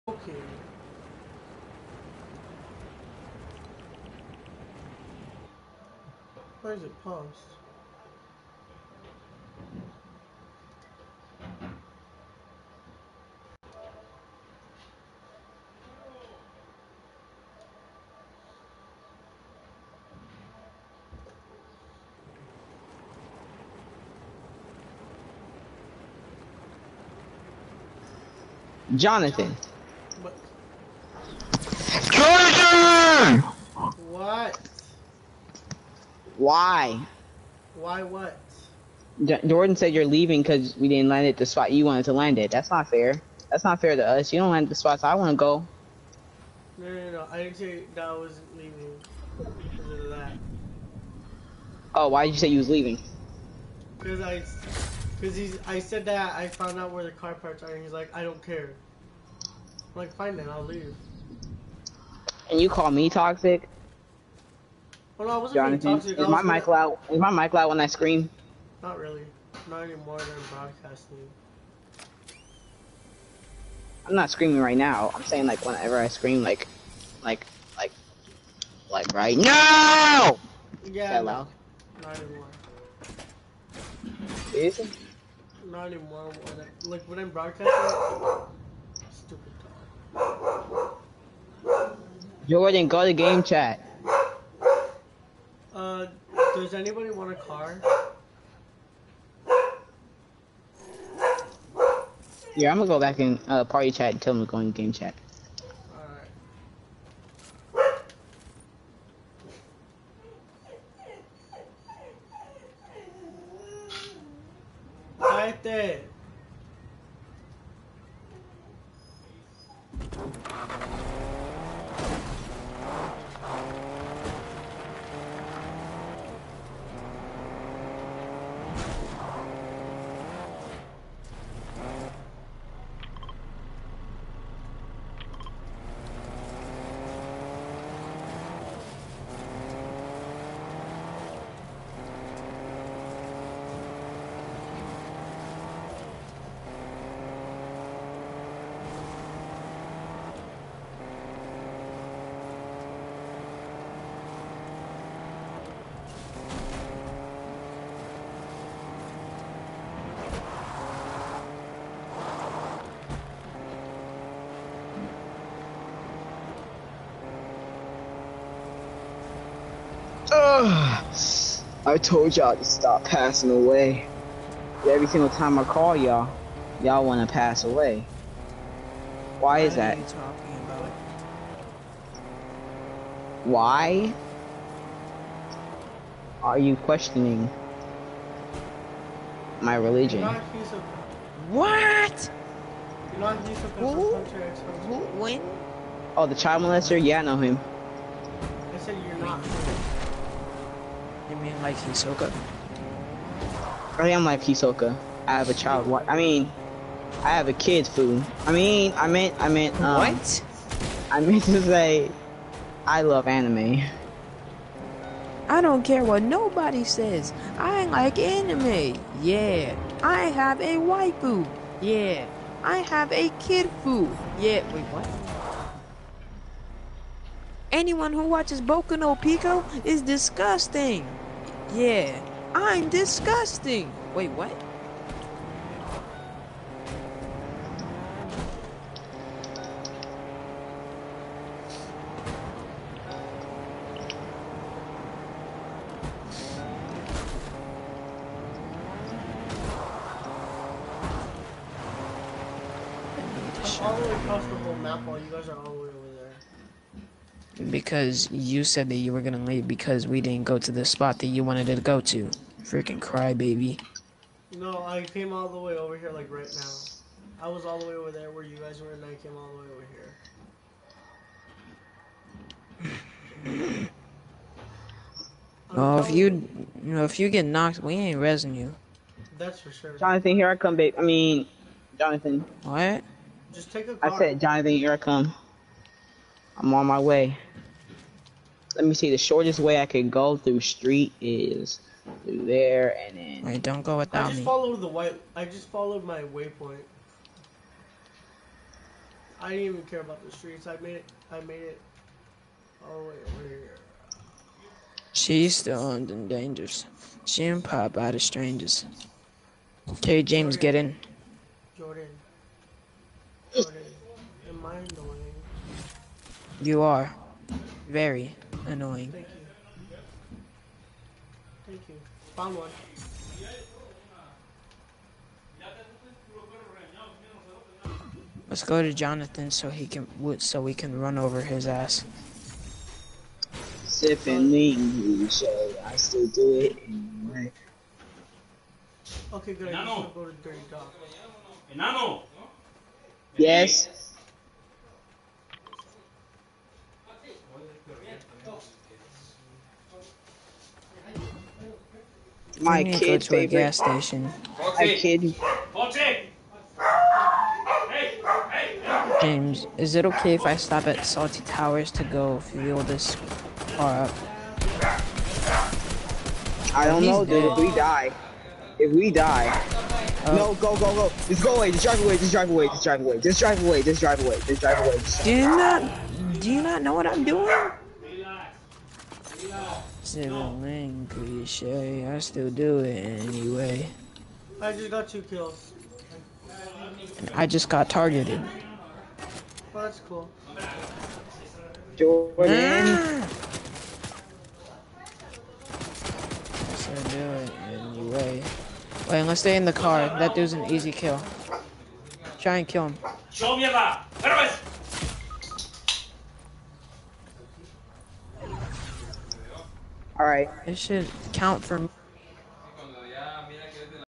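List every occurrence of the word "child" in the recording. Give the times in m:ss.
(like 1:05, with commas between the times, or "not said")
3:16, 3:25.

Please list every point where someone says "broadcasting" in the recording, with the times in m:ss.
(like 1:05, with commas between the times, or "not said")
1:10, 1:27.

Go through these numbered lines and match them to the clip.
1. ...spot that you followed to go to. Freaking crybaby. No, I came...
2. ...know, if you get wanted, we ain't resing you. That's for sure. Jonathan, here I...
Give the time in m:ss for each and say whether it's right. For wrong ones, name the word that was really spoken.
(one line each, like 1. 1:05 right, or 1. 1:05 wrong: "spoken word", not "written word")
1. 4:20 wrong: "wanted", not "followed"
2. 4:36 wrong: "knocked", not "wanted".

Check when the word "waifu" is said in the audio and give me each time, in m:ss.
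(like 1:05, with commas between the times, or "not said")
3:40.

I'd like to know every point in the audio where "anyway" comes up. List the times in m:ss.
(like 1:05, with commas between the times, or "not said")
5:36, 6:23, 6:37.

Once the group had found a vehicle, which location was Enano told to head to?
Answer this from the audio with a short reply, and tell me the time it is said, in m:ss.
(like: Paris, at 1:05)
Dirty Dog, at 5:40.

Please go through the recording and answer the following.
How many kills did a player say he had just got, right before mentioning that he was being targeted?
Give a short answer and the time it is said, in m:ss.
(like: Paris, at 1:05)
2, at 6:25.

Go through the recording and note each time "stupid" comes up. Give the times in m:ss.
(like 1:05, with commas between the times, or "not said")
1:29.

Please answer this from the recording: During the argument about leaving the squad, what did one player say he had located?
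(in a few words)
car parts.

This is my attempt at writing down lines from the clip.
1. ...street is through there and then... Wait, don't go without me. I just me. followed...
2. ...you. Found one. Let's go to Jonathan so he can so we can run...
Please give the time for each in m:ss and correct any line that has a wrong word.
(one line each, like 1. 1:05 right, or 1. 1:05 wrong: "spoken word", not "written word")
1. 4:50 right
2. 5:21 right.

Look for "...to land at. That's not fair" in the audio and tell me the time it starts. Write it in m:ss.
0:42.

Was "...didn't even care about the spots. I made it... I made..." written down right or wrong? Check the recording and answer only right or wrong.
wrong.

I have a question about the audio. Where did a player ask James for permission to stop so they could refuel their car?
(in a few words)
Salty Towers.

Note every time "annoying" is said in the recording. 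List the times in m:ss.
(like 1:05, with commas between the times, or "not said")
5:18.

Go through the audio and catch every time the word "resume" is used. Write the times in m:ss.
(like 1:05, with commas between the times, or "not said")
not said.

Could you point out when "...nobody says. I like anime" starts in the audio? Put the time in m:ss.
3:36.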